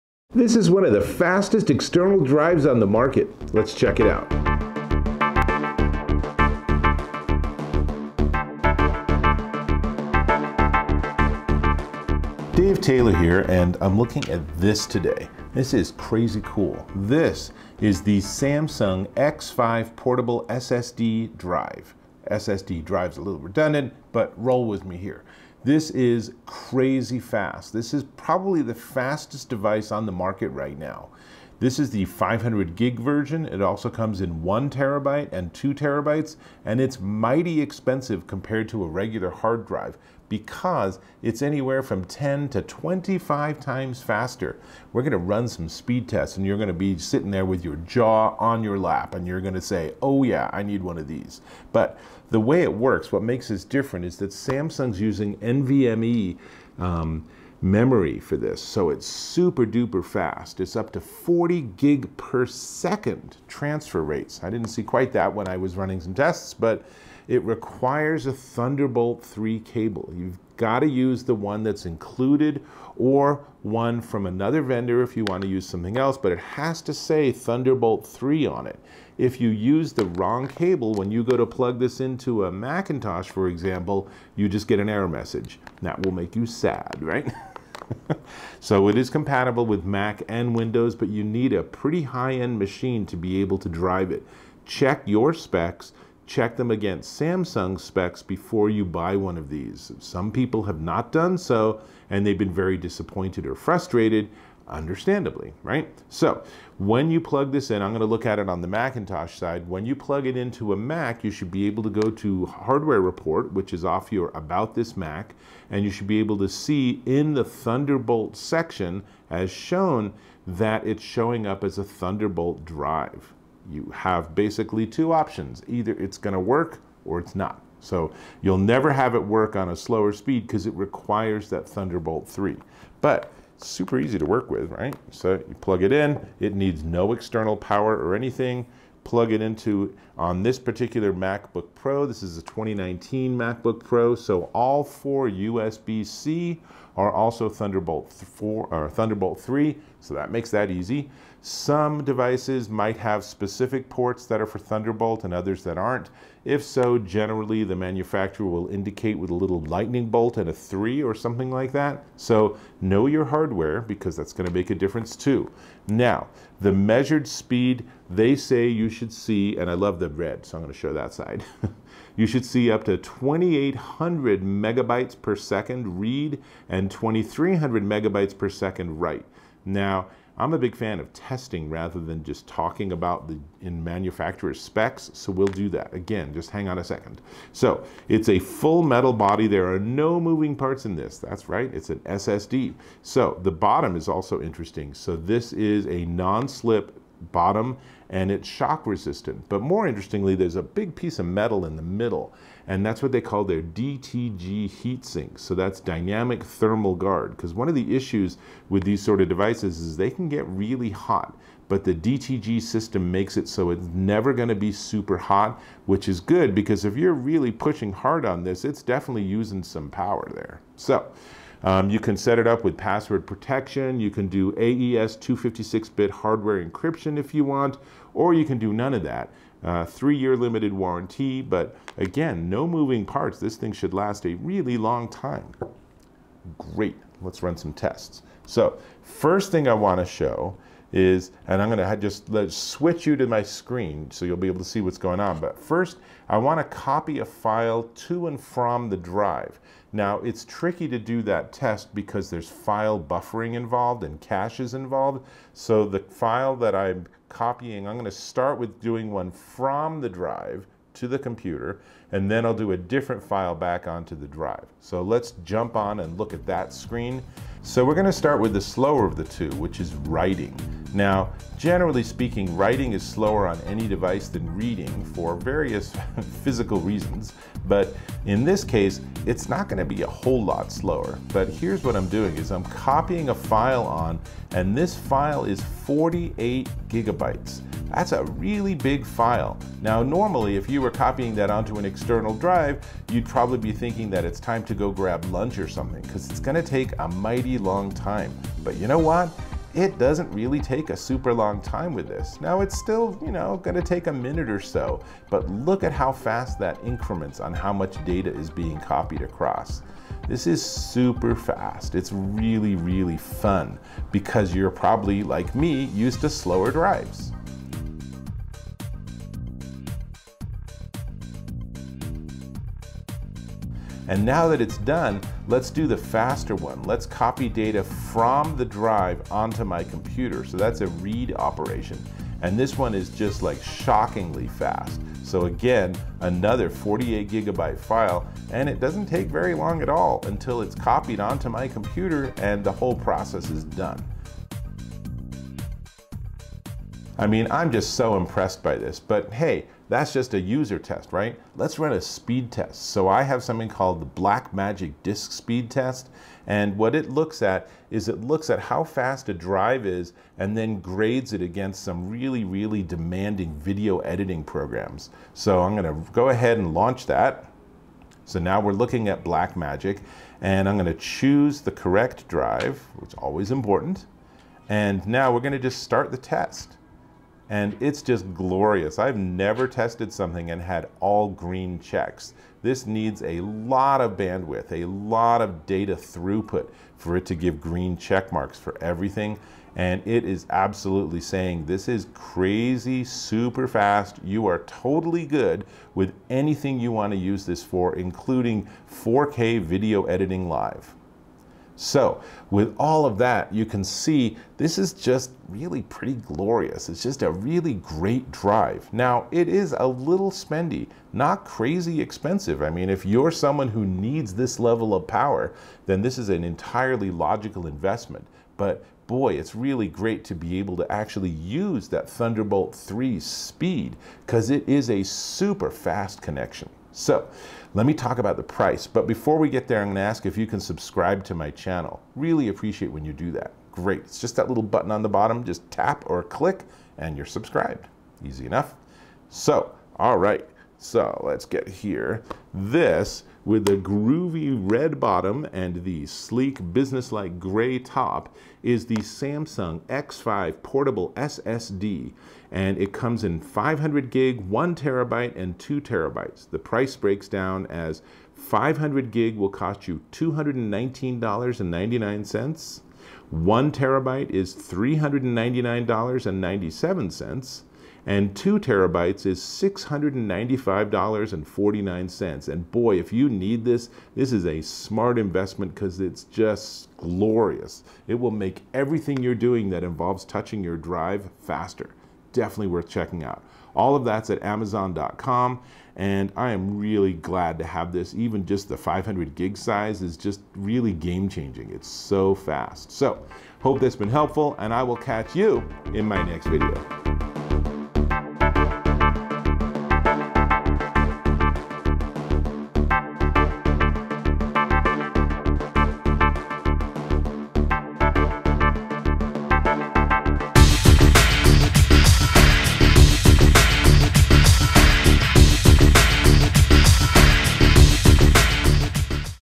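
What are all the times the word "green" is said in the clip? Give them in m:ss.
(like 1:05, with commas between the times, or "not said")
6:21, 6:27.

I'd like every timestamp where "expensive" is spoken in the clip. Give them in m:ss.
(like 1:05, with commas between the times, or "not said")
0:37, 6:51.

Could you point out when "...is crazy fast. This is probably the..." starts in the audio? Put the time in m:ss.
0:25.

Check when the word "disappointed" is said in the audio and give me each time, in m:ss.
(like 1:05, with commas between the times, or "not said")
1:42.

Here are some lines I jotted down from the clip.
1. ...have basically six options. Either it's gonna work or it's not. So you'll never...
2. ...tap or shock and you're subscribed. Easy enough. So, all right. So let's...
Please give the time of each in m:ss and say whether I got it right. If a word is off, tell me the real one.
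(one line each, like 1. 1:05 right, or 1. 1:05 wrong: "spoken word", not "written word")
1. 2:03 wrong: "two", not "six"
2. 7:15 wrong: "click", not "shock".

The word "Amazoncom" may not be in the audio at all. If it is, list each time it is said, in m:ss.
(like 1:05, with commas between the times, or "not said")
8:04.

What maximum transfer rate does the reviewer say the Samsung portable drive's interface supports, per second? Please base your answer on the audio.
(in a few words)
40 gig.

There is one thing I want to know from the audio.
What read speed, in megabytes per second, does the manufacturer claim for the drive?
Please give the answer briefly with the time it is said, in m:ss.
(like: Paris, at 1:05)
2,800, at 2:52.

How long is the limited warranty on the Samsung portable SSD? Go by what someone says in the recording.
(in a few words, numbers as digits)
three-year.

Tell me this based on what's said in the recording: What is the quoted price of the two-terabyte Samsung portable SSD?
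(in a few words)
$695.49.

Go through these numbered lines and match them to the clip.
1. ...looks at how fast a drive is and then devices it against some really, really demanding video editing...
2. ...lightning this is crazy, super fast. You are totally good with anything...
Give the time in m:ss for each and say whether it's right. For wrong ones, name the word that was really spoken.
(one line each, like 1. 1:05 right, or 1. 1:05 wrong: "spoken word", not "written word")
1. 5:58 wrong: "grades", not "devices"
2. 6:31 wrong: "saying", not "lightning".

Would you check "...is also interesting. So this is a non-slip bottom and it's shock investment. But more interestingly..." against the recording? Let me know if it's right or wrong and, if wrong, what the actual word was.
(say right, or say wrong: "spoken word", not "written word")
wrong: "resistant", not "investment".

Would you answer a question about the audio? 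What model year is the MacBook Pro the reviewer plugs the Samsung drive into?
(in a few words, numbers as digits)
2019.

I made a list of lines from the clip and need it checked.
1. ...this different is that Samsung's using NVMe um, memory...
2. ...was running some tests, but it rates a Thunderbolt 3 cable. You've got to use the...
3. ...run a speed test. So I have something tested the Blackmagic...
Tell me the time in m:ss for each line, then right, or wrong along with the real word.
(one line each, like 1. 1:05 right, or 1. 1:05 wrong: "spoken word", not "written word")
1. 0:53 right
2. 1:05 wrong: "requires", not "rates"
3. 5:51 wrong: "called", not "tested".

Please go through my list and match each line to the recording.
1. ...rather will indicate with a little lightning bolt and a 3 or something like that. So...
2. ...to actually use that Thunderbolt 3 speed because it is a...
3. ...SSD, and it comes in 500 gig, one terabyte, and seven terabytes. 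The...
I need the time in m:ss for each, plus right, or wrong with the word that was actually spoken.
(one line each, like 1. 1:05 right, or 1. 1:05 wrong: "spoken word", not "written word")
1. 2:37 wrong: "manufacturer", not "rather"
2. 7:00 right
3. 7:31 wrong: "two", not "seven".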